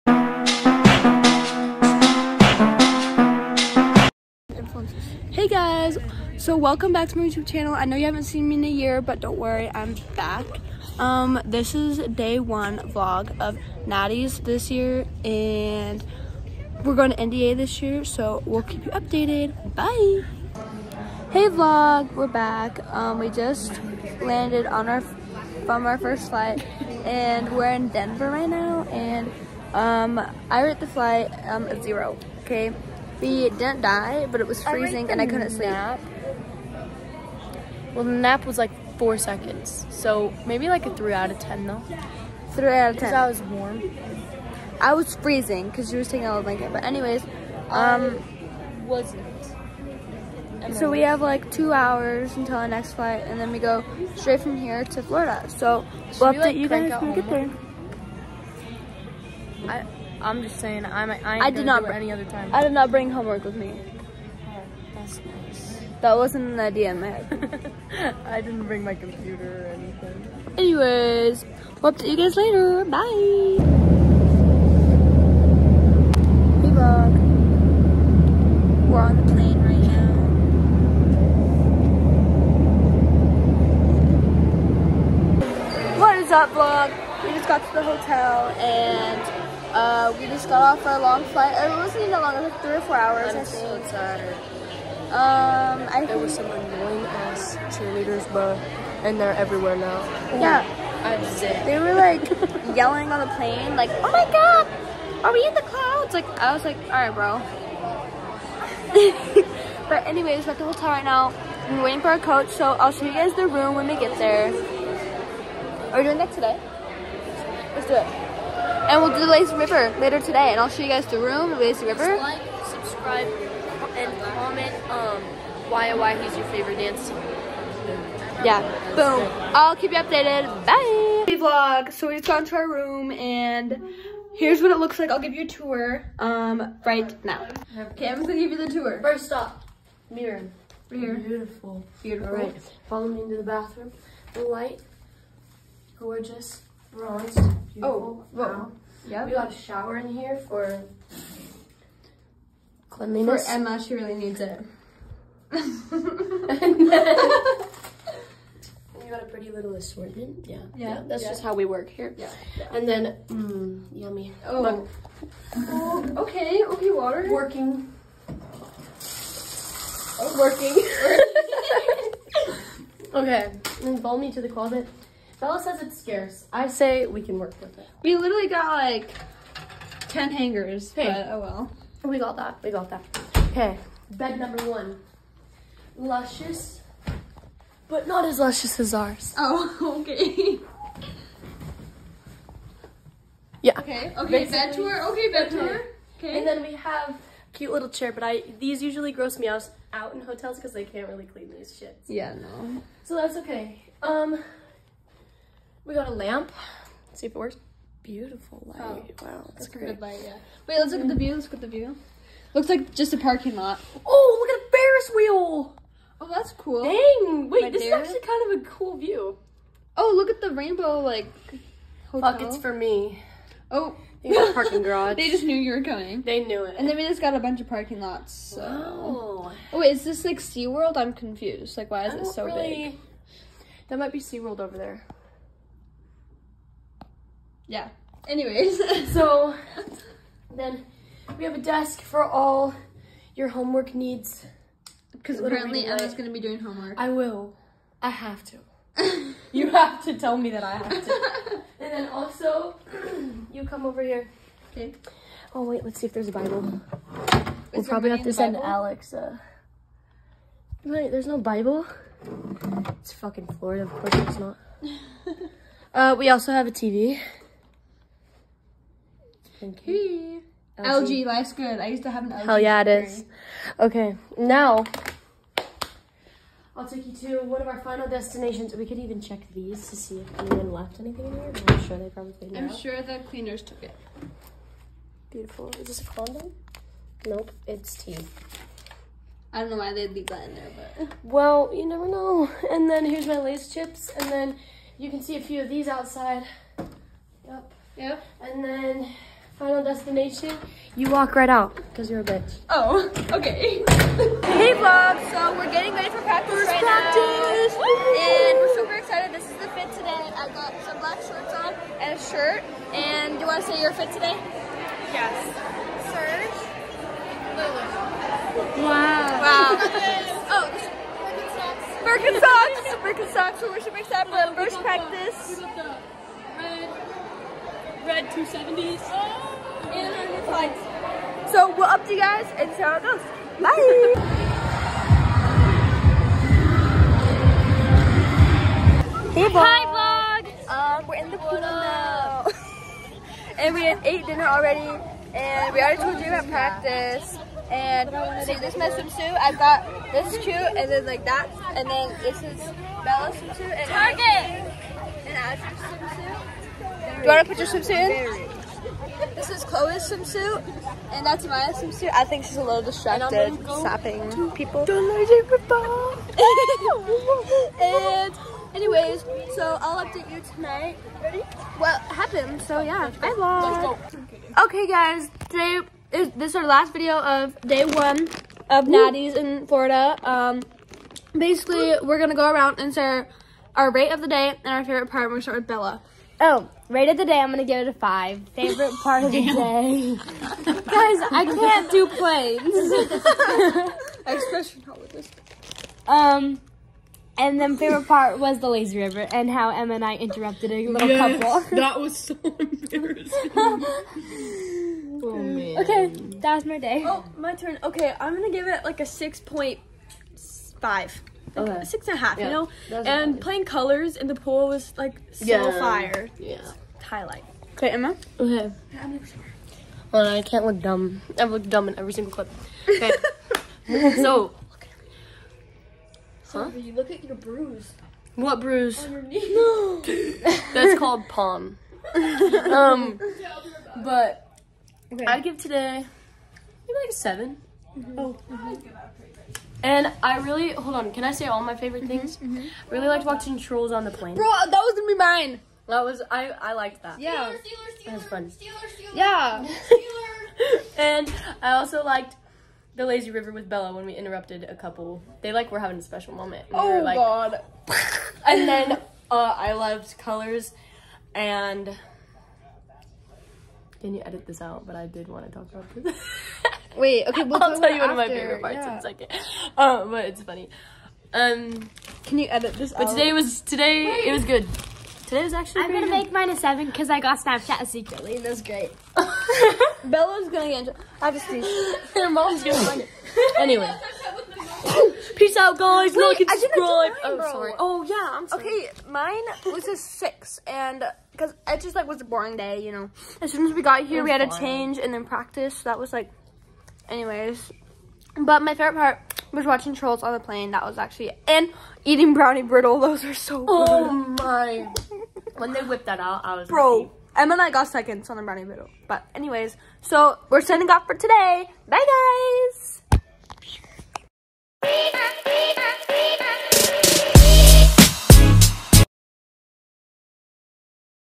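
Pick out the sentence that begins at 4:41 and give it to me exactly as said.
I'm sure they probably cleaned I'm out.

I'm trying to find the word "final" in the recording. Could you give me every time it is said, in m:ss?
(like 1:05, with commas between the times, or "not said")
4:37, 4:59.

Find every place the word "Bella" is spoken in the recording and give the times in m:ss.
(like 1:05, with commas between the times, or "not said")
2:55, 5:53, 6:25, 7:33, 8:00.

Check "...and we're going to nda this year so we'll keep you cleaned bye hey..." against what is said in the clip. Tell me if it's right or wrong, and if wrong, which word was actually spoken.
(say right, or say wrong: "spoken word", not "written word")
wrong: "updated", not "cleaned".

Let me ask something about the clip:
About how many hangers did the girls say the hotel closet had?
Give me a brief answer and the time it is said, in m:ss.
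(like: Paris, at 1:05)
10, at 3:00.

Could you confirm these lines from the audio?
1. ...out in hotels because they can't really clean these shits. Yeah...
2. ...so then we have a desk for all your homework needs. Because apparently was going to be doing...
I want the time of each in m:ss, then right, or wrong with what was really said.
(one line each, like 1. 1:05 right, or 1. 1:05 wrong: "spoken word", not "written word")
1. 3:19 right
2. 3:59 right.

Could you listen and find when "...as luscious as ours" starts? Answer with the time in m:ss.
3:08.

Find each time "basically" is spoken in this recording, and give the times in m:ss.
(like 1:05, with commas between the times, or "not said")
3:14, 6:21.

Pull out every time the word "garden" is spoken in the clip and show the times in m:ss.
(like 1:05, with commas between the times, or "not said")
not said.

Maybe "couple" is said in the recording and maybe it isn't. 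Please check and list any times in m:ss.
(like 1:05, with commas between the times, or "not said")
6:41, 7:34.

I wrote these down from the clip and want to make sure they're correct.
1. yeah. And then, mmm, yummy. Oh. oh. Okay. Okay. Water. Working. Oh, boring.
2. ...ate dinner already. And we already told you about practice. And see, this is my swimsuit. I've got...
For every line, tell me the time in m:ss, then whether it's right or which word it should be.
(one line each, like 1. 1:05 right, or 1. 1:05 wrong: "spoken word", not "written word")
1. 2:42 wrong: "working", not "boring"
2. 5:43 right.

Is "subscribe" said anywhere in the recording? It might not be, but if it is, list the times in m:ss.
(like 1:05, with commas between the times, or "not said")
2:02, 8:06.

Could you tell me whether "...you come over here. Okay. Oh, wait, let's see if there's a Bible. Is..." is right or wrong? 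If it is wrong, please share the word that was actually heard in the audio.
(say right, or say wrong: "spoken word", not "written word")
right.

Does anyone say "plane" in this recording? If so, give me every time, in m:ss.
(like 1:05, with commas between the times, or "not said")
1:19, 1:43, 6:32, 7:24, 8:20.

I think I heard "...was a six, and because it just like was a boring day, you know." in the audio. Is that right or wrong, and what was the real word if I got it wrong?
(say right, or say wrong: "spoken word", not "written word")
right.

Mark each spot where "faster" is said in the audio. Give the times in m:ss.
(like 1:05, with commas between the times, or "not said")
not said.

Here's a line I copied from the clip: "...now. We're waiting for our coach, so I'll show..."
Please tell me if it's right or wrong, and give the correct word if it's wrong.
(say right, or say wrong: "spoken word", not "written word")
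right.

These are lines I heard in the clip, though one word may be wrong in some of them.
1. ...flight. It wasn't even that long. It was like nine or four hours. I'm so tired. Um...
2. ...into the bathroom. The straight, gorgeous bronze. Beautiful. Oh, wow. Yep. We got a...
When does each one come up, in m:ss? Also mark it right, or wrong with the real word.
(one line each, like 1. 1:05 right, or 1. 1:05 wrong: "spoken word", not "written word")
1. 1:31 wrong: "three", not "nine"
2. 2:23 wrong: "light", not "straight".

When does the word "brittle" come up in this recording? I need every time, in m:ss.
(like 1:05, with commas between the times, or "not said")
8:22, 8:28.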